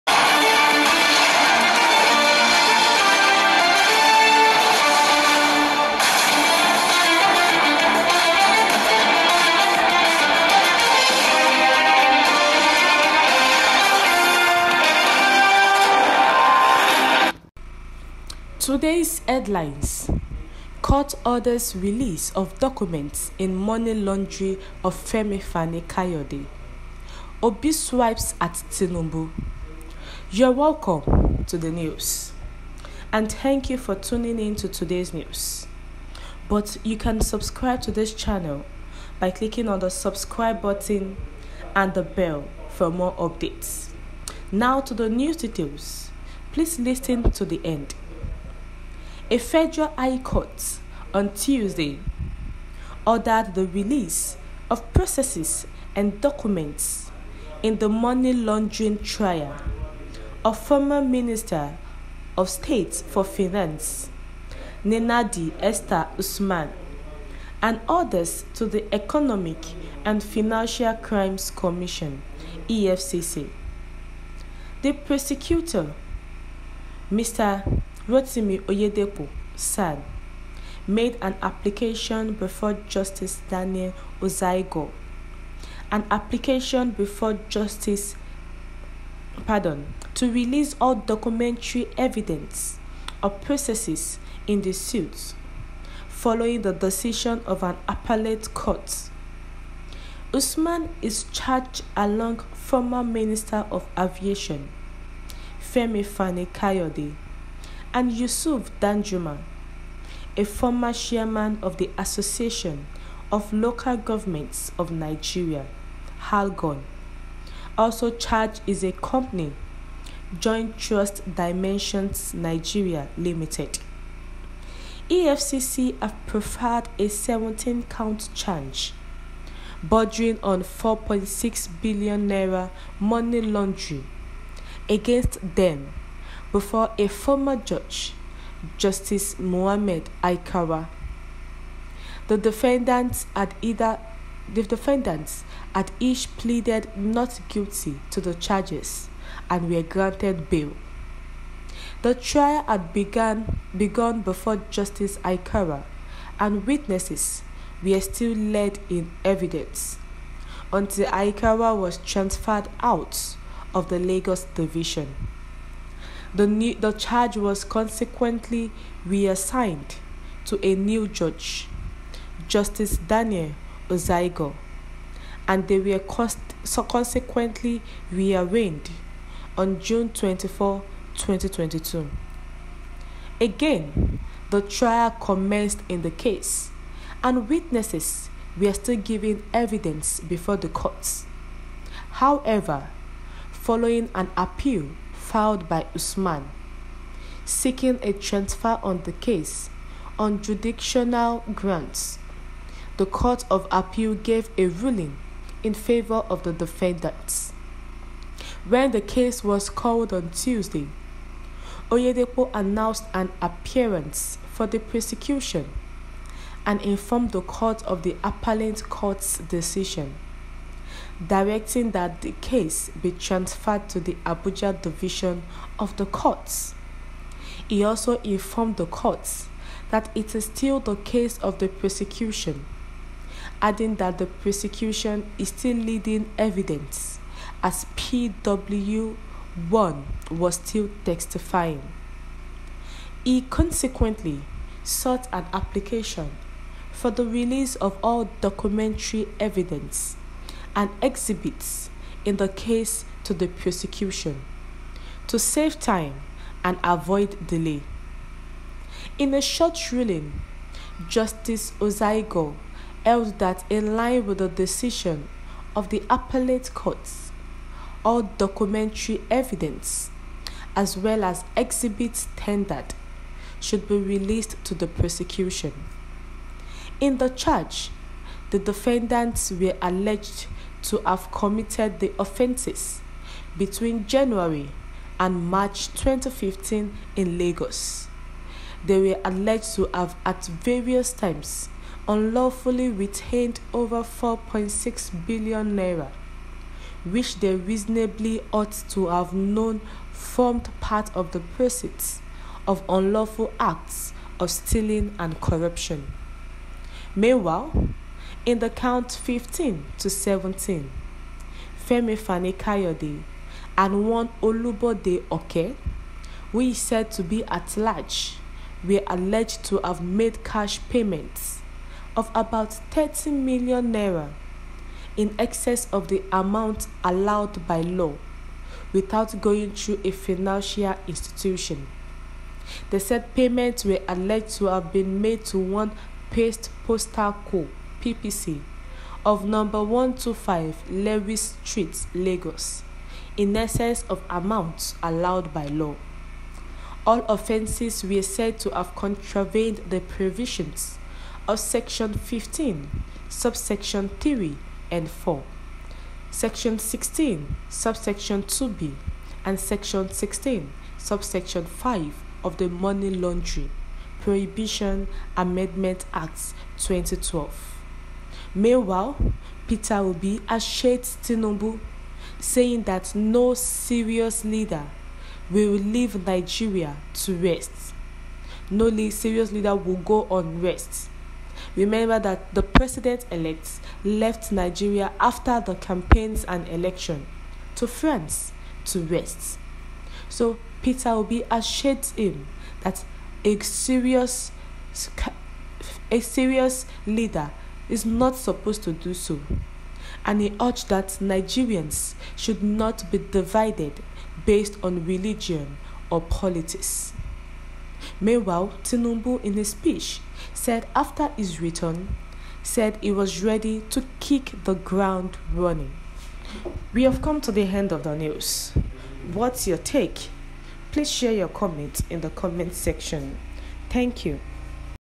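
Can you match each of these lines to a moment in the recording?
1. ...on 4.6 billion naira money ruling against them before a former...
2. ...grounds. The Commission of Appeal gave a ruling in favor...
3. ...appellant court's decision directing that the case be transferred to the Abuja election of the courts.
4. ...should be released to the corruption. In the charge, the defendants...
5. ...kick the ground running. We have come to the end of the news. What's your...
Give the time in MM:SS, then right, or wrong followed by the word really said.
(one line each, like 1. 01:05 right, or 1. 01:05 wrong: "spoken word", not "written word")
1. 02:10 wrong: "laundering", not "ruling"
2. 03:21 wrong: "Court", not "Commission"
3. 03:38 wrong: "division", not "election"
4. 04:33 wrong: "prosecution", not "corruption"
5. 06:54 right.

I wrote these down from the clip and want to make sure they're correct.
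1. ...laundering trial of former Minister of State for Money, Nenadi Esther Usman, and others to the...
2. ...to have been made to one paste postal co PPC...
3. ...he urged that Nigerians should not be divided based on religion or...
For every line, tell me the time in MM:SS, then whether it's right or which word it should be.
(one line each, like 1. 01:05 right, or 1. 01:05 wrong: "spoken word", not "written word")
1. 00:58 wrong: "Finance", not "Money"
2. 05:34 right
3. 06:40 right.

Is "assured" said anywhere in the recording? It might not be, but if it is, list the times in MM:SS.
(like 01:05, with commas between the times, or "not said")
06:10, 06:31.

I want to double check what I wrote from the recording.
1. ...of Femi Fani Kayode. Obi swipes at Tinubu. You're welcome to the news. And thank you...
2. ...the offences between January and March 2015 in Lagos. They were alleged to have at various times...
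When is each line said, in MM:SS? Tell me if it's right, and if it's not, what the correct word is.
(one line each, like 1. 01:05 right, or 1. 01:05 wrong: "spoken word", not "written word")
1. 00:24 right
2. 04:41 right.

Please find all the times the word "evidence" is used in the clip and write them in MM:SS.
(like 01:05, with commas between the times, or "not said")
01:31, 02:39, 03:09, 03:56, 04:09, 04:29.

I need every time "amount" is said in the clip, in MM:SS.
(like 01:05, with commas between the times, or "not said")
05:26, 05:44.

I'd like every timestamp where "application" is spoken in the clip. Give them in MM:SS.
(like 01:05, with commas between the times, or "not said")
01:21, 01:26, 04:05.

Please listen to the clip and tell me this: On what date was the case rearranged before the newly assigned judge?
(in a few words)
June 24, 2022.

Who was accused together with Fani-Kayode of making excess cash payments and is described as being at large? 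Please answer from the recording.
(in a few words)
Olubode Oke.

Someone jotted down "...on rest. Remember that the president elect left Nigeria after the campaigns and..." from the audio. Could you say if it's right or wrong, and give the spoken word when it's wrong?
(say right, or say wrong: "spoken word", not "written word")
right.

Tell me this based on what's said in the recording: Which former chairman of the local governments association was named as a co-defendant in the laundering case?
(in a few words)
Yusuf Danjuma.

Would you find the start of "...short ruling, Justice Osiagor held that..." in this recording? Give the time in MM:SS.
04:19.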